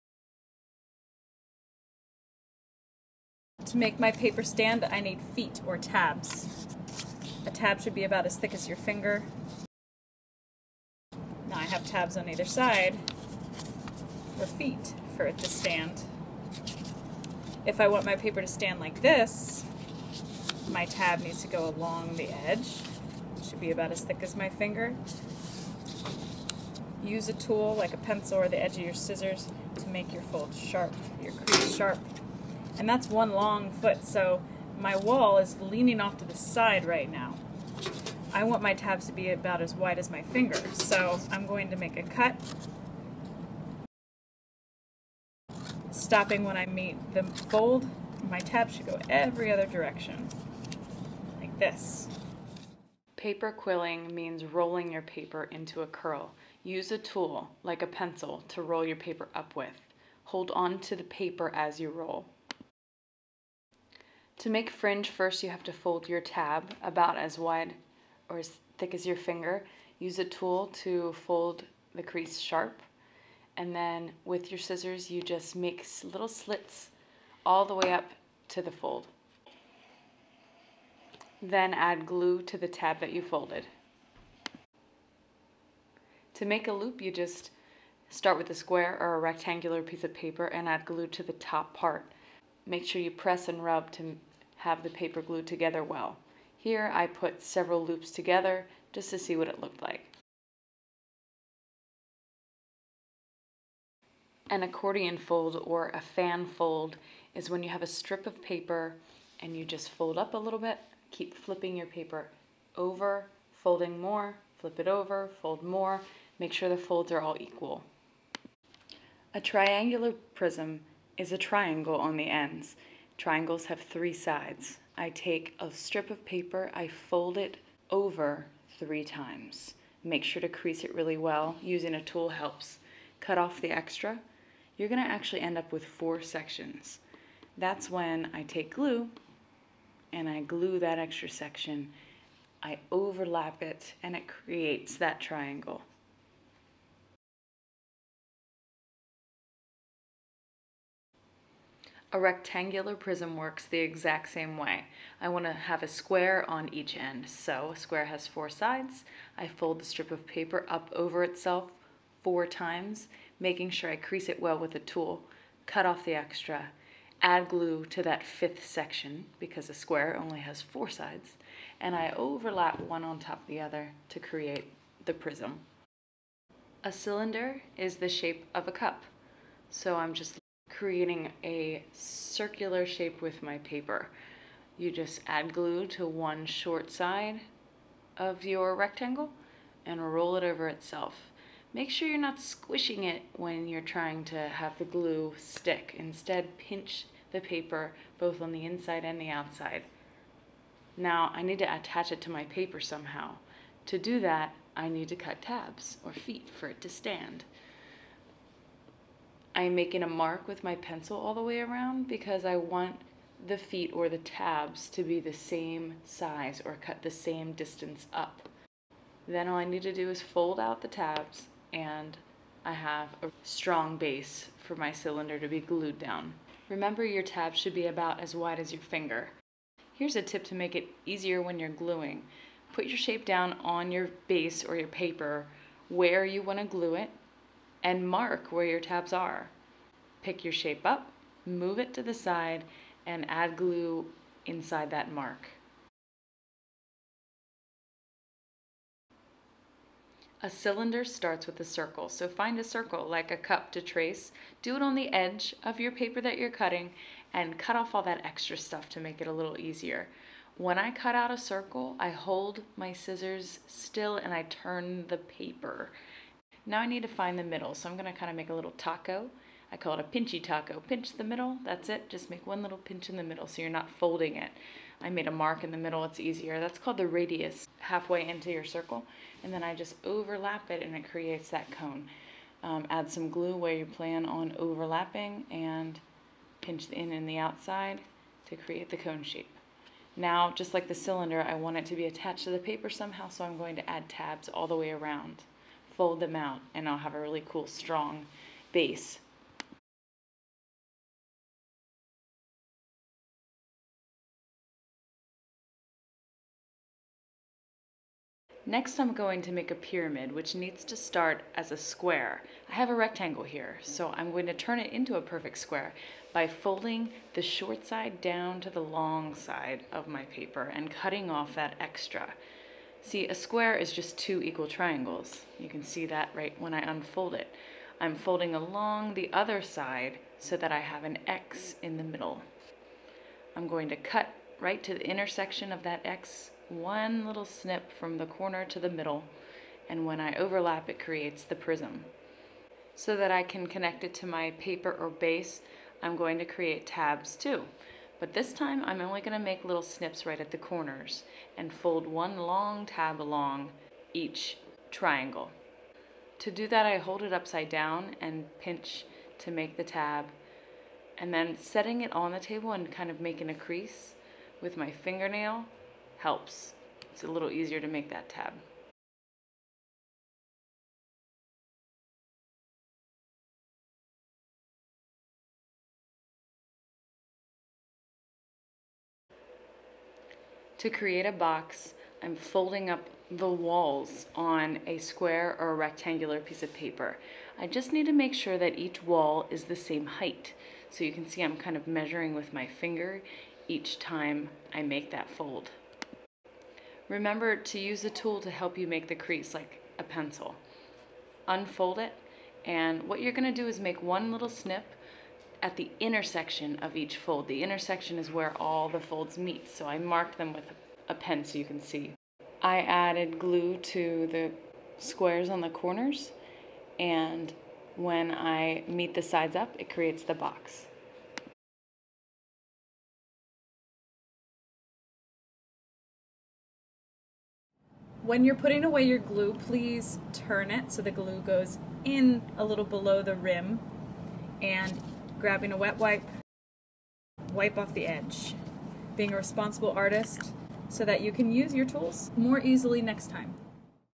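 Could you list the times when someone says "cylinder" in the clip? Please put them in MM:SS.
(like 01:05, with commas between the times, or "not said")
02:56, 03:44, 04:10, 04:50.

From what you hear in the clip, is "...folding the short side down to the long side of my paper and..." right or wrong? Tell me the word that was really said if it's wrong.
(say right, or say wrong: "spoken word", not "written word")
right.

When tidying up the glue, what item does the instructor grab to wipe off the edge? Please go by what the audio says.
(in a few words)
A wet wipe.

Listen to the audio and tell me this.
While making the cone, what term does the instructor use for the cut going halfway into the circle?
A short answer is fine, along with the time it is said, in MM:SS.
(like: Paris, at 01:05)
Radius, at 04:37.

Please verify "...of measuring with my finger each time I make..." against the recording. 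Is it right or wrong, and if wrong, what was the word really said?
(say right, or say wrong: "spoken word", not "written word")
right.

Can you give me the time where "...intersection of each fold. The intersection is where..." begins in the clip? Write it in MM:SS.
06:45.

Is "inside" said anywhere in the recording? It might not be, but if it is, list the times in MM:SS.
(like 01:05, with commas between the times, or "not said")
03:18, 04:04.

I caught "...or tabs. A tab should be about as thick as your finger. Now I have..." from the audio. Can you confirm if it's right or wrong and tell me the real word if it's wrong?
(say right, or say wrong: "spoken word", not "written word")
right.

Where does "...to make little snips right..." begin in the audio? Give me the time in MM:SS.
05:49.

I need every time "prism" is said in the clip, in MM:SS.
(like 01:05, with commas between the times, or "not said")
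02:00, 02:32, 02:55, 05:41.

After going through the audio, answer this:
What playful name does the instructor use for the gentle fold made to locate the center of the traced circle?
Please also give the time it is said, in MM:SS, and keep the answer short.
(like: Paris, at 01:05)
Pinchy taco, at 04:30.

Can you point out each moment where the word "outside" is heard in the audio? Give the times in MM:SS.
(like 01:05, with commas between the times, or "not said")
03:19, 04:47.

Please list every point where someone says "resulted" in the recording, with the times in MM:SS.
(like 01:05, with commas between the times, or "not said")
not said.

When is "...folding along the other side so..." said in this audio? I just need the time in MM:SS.
05:28.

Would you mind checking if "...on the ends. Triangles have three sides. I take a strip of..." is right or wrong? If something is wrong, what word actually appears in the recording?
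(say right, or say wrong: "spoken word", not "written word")
right.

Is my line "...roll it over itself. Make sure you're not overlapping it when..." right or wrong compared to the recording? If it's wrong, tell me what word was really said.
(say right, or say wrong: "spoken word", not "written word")
wrong: "squishing", not "overlapping".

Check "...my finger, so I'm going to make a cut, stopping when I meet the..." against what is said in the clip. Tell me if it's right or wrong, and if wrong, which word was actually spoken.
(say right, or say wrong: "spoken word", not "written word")
right.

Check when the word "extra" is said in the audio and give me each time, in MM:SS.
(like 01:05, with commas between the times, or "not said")
02:13, 02:20, 02:46, 04:18, 05:21.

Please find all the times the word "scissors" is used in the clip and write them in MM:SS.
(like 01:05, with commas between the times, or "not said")
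00:28, 01:14, 04:22.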